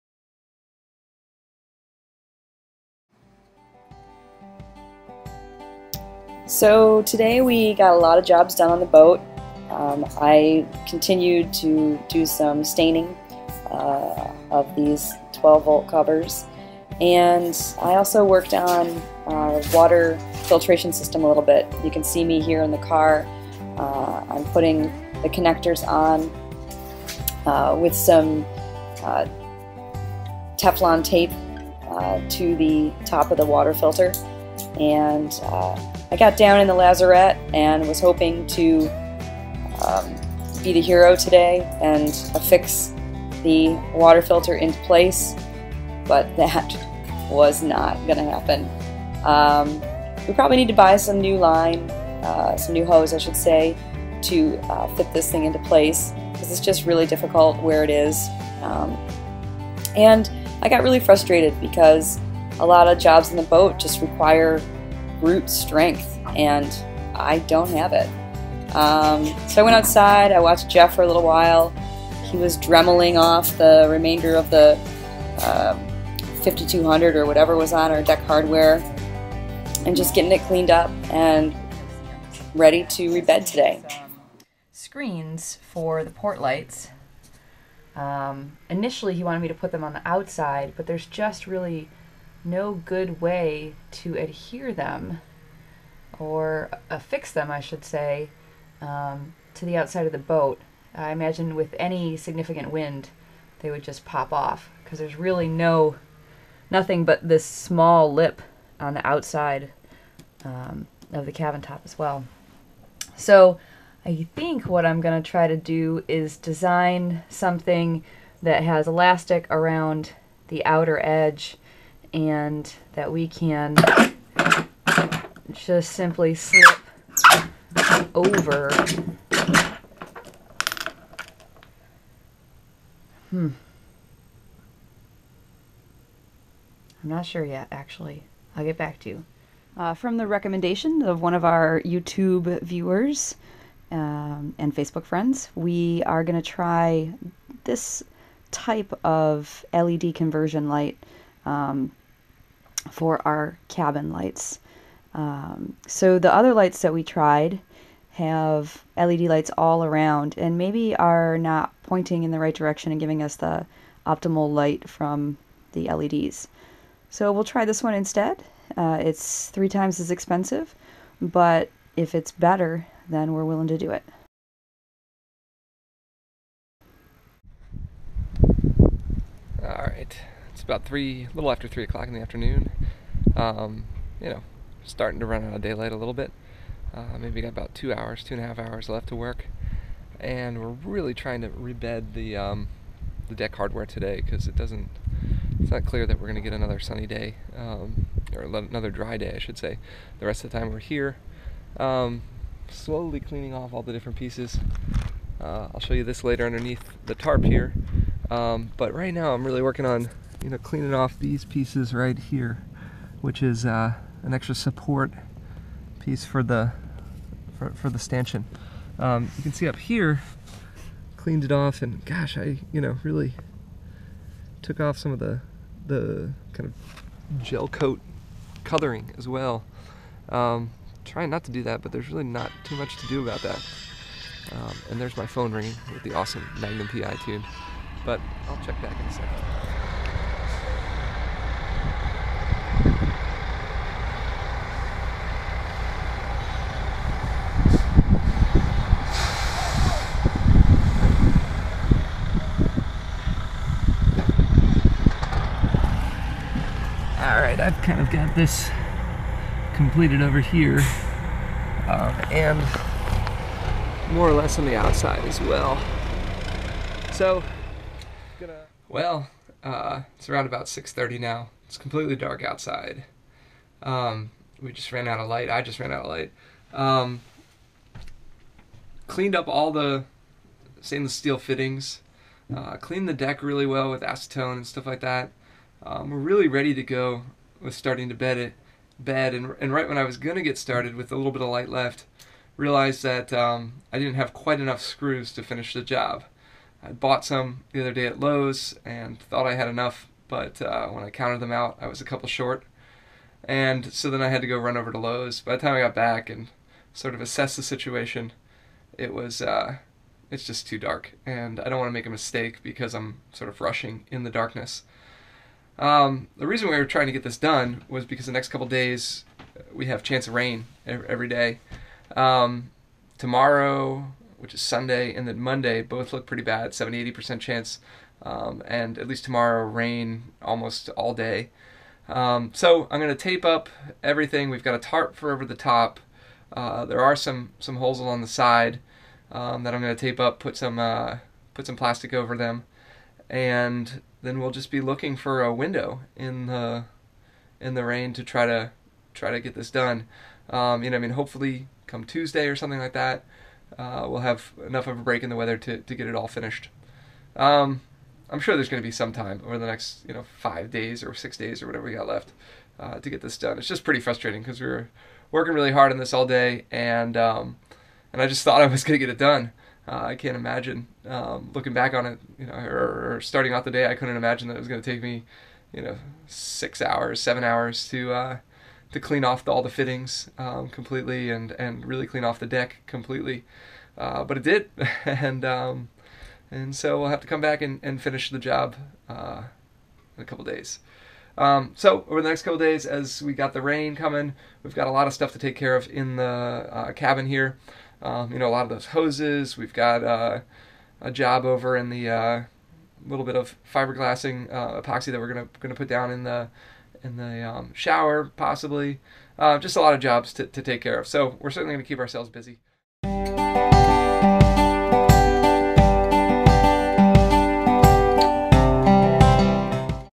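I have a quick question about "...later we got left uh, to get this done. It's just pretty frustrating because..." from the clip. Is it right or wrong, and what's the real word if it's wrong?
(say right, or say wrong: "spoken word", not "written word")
wrong: "whatever", not "later".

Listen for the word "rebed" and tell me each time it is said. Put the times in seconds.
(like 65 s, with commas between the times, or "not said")
83 s, 191 s.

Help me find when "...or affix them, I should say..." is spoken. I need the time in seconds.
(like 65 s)
96 s.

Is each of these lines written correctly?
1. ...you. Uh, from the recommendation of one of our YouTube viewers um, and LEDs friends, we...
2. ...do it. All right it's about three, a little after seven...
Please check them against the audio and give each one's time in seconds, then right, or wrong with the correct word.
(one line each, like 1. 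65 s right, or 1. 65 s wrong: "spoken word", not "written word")
1. 139 s wrong: "Facebook", not "LEDs"
2. 173 s wrong: "three", not "seven".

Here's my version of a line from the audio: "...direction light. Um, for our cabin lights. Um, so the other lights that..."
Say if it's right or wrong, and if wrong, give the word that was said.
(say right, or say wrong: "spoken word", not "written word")
wrong: "conversion", not "direction".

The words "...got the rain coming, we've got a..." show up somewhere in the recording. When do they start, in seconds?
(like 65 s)
393 s.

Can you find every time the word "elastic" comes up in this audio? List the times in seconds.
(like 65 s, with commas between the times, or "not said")
118 s.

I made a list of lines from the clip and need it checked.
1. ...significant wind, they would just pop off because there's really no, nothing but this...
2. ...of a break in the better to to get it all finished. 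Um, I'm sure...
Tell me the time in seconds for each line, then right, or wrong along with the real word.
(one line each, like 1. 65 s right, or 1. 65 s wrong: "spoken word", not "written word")
1. 102 s right
2. 354 s wrong: "weather", not "better".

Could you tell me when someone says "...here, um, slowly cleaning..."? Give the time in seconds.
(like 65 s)
200 s.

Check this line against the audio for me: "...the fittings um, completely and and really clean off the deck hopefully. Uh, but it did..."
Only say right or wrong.
wrong.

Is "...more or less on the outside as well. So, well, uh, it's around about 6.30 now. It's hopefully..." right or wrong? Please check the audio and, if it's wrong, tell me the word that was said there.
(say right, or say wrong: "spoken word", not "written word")
wrong: "completely", not "hopefully".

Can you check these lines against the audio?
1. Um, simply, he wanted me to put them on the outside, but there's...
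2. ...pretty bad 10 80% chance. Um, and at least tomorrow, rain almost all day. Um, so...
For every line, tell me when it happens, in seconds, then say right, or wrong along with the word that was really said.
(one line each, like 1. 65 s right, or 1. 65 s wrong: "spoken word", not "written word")
1. 87 s wrong: "initially", not "simply"
2. 326 s wrong: "70", not "10".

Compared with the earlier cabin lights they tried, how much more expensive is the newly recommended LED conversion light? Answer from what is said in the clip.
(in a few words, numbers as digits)
3 times.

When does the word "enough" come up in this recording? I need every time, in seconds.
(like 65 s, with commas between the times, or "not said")
294 s, 299 s, 354 s.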